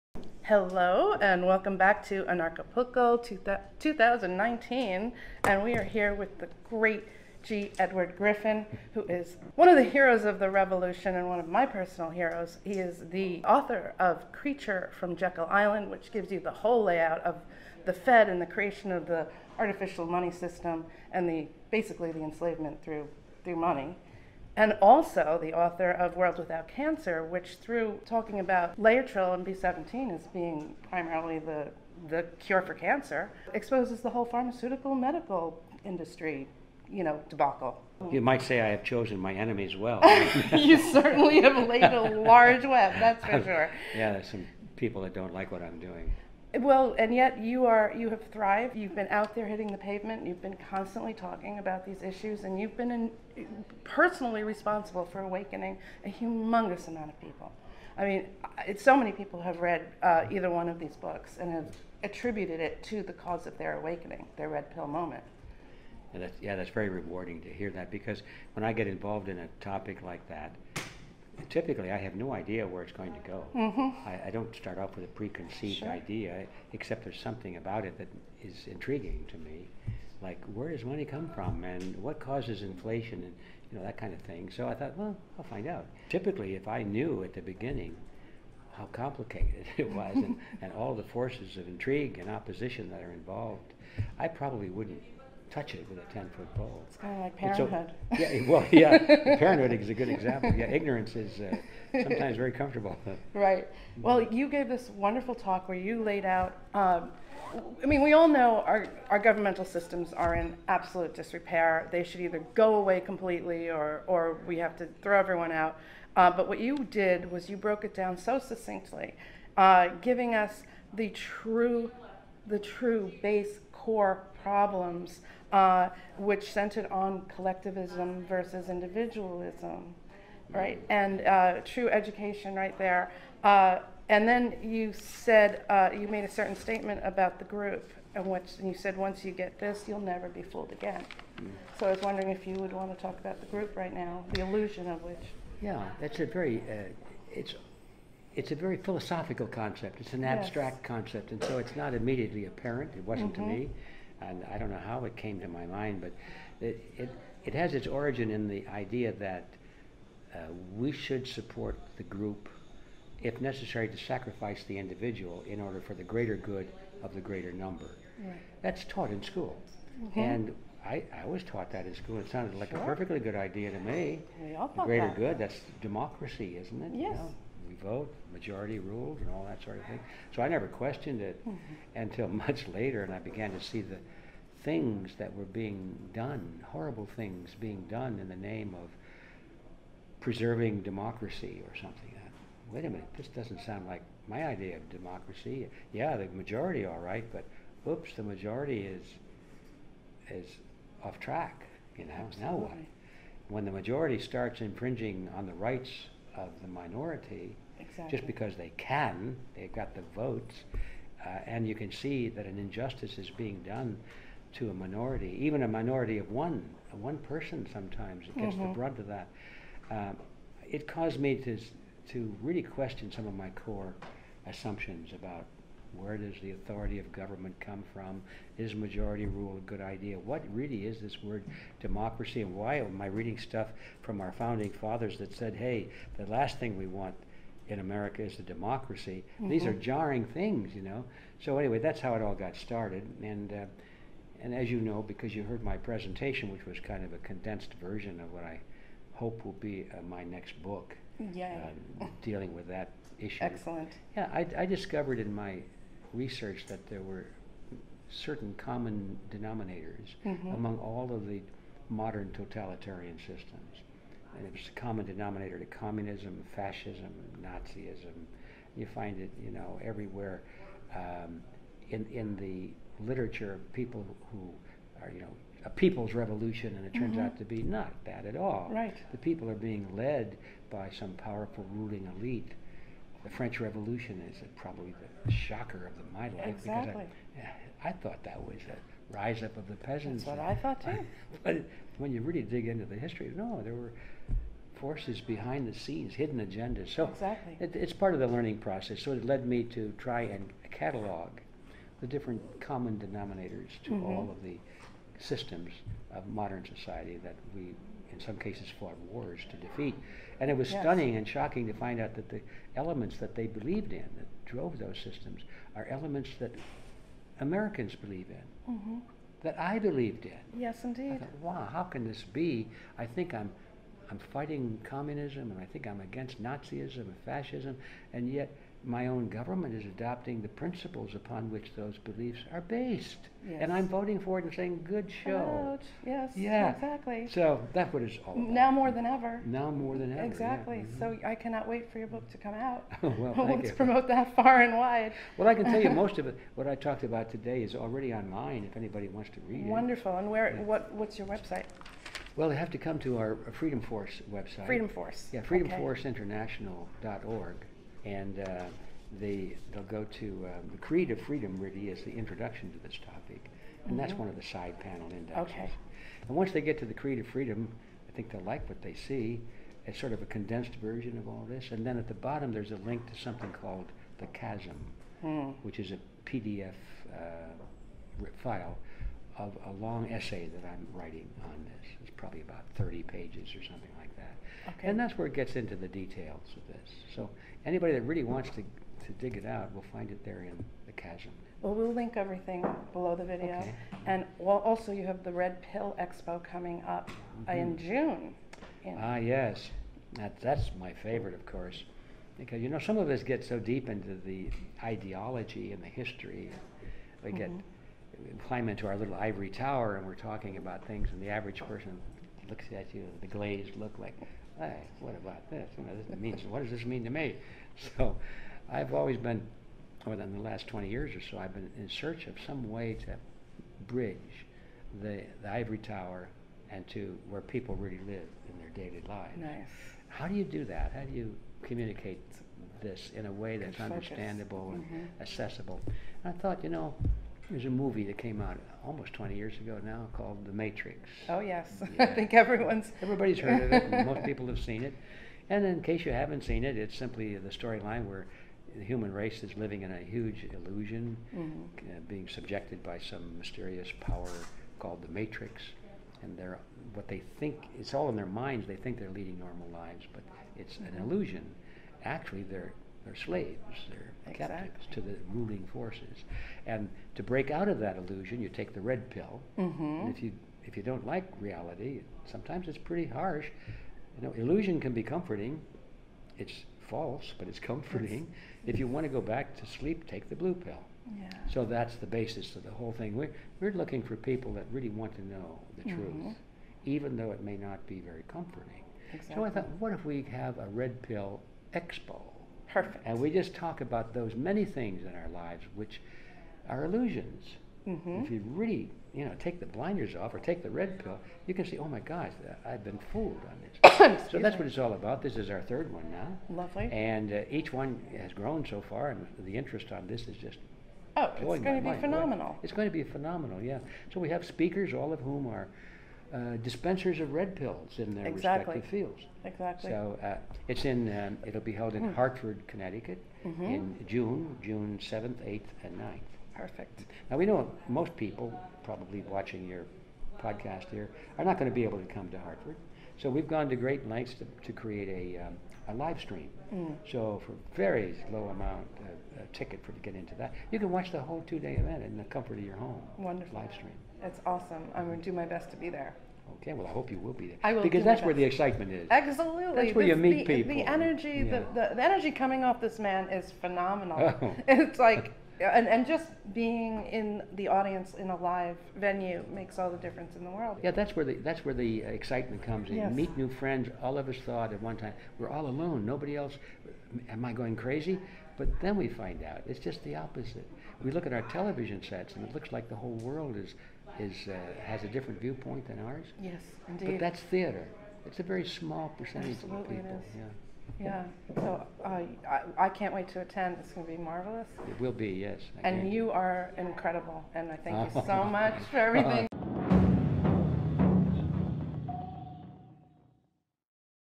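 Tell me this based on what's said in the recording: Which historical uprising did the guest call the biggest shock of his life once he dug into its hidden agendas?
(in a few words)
French Revolution.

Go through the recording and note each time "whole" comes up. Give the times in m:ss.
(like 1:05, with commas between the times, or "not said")
0:16, 0:34, 8:02, 9:01, 9:32.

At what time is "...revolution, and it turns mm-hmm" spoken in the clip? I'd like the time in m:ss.
4:36.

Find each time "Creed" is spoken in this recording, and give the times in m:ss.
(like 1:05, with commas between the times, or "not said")
6:00, 6:06.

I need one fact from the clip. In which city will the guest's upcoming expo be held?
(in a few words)
Hartford, Connecticut.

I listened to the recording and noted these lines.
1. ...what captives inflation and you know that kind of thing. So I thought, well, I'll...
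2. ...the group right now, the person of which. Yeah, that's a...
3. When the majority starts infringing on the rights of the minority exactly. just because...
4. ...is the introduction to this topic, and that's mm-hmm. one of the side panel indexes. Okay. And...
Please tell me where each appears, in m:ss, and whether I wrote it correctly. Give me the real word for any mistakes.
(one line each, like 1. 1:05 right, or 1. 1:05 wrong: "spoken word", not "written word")
1. 1:22 wrong: "causes", not "captives"
2. 2:23 wrong: "illusion", not "person"
3. 3:23 right
4. 6:01 right.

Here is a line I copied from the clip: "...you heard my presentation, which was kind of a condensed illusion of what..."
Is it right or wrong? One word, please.
wrong.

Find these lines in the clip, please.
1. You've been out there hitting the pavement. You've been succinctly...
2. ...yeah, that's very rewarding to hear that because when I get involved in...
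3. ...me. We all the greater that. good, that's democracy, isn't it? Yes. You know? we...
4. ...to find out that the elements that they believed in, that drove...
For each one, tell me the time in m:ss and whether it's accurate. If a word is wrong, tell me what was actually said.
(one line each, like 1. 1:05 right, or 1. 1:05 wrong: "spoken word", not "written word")
1. 0:48 wrong: "constantly", not "succinctly"
2. 1:06 right
3. 2:53 right
4. 5:11 right.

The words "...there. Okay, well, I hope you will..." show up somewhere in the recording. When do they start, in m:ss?
9:05.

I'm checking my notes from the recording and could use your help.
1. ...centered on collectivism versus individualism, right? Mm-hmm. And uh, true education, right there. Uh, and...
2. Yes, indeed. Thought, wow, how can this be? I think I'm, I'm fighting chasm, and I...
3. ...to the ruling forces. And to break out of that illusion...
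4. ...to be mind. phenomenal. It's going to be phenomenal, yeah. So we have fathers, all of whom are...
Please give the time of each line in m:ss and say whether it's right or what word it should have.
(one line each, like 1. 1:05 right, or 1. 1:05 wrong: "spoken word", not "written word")
1. 2:06 right
2. 5:20 wrong: "communism", not "chasm"
3. 7:44 right
4. 8:31 wrong: "speakers", not "fathers".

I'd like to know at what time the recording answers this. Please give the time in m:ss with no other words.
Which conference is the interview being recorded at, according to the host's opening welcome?
0:02.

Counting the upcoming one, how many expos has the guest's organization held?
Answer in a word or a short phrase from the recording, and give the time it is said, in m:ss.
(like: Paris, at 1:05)
3, at 8:25.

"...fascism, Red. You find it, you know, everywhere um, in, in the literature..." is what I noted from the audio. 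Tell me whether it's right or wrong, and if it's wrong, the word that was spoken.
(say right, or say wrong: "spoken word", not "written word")
wrong: "Nazism", not "Red".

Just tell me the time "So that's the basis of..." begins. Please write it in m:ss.
8:01.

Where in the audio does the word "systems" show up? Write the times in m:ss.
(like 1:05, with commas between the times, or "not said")
0:20, 1:49, 4:23, 5:05, 5:15.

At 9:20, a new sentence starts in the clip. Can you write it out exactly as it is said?
Yeah, that's where the that's where the uh, excitement comes in.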